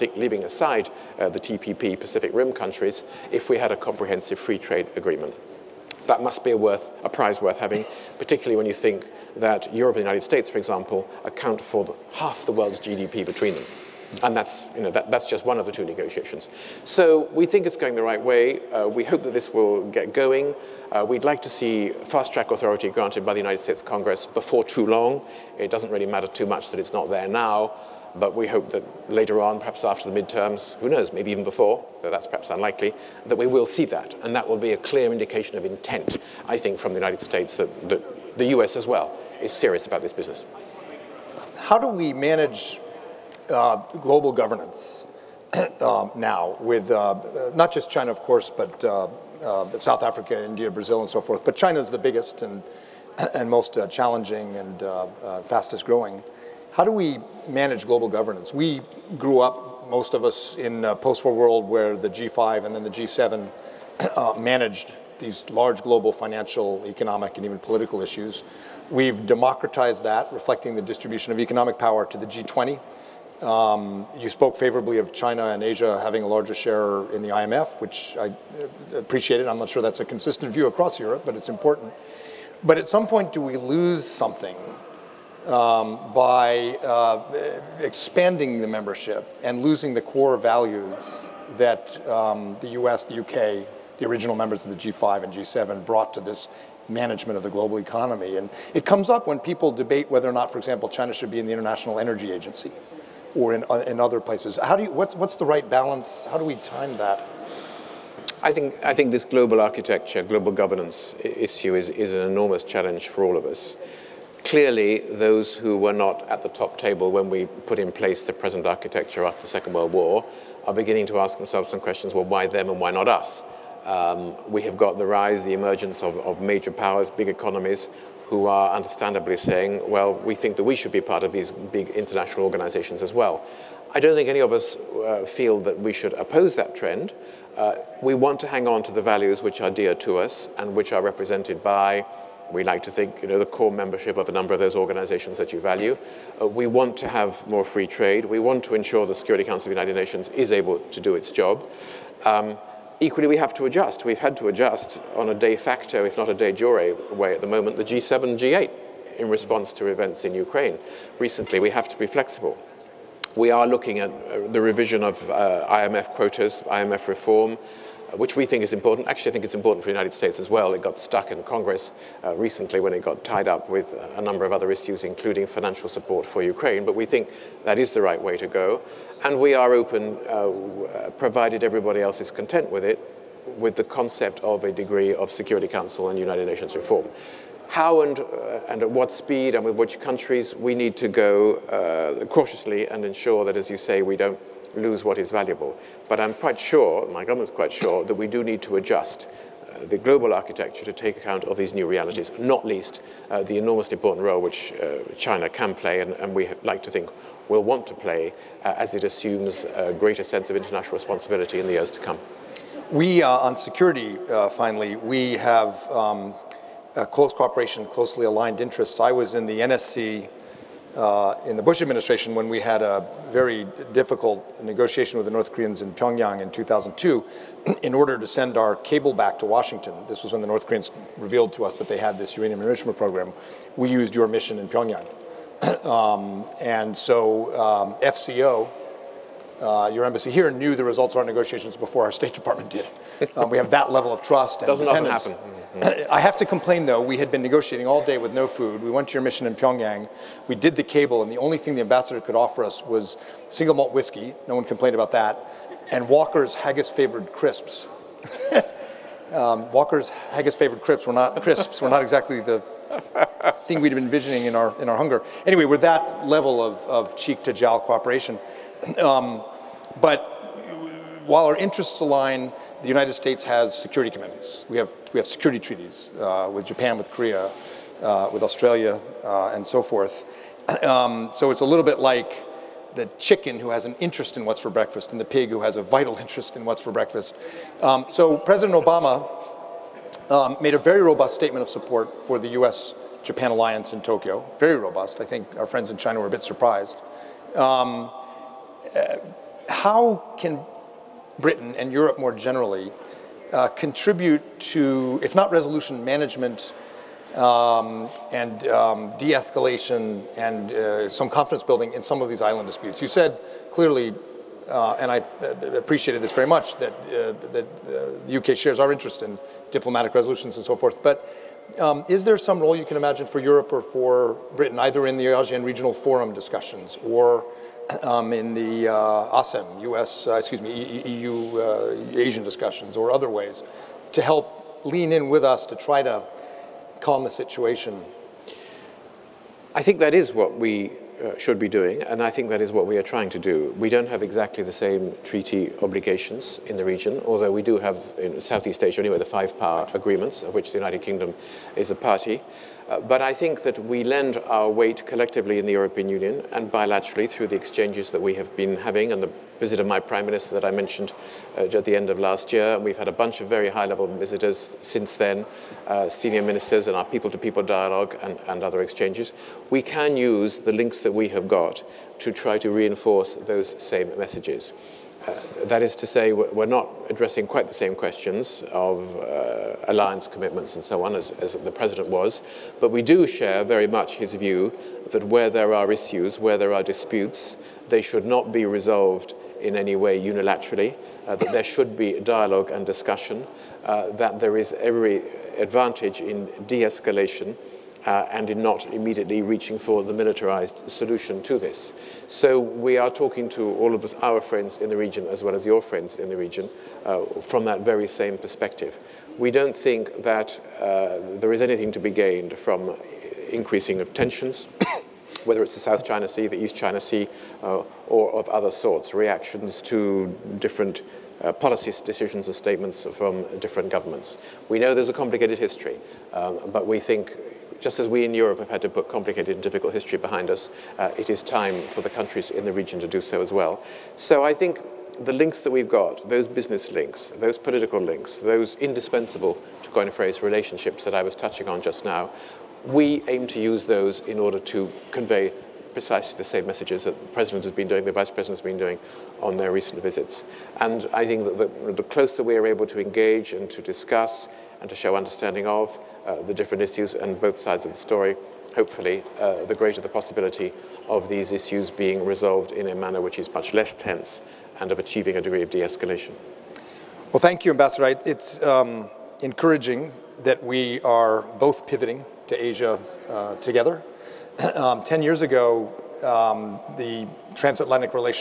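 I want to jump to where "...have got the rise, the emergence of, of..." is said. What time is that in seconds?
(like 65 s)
124 s.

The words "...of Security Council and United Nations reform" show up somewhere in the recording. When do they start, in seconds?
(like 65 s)
185 s.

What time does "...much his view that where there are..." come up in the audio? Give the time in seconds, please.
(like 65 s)
383 s.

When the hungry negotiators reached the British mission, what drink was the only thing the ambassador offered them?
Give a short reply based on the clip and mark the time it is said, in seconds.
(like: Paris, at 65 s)
single malt whiskey, at 253 s.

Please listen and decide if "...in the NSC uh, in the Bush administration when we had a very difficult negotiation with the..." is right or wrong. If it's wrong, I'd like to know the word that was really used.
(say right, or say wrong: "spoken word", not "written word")
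right.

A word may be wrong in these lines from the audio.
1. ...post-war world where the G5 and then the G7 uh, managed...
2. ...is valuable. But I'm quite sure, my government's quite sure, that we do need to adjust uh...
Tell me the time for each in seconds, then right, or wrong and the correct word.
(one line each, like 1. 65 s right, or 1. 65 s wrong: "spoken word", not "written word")
1. 60 s right
2. 195 s right.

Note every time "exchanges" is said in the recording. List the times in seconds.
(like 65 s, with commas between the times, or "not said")
357 s, 368 s.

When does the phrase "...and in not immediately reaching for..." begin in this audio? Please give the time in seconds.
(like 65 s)
398 s.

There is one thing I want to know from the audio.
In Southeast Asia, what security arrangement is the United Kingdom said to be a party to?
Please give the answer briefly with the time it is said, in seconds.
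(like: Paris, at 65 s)
five power agreements, at 349 s.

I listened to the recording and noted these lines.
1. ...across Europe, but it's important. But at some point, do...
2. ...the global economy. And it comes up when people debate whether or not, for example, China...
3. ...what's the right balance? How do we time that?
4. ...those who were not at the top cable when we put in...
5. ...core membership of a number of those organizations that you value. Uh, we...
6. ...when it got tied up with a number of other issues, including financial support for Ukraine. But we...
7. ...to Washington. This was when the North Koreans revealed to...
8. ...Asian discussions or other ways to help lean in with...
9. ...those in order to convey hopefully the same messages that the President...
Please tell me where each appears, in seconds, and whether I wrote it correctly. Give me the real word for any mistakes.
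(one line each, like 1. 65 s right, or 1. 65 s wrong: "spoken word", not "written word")
1. 80 s right
2. 97 s right
3. 105 s right
4. 115 s wrong: "table", not "cable"
5. 143 s right
6. 172 s right
7. 229 s right
8. 332 s right
9. 443 s wrong: "precisely", not "hopefully".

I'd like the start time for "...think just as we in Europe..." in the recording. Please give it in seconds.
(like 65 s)
426 s.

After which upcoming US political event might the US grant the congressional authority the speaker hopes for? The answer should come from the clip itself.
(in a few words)
midterms.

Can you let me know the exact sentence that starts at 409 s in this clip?
We don't think that uh, there is anything to be gained from increasing of tensions.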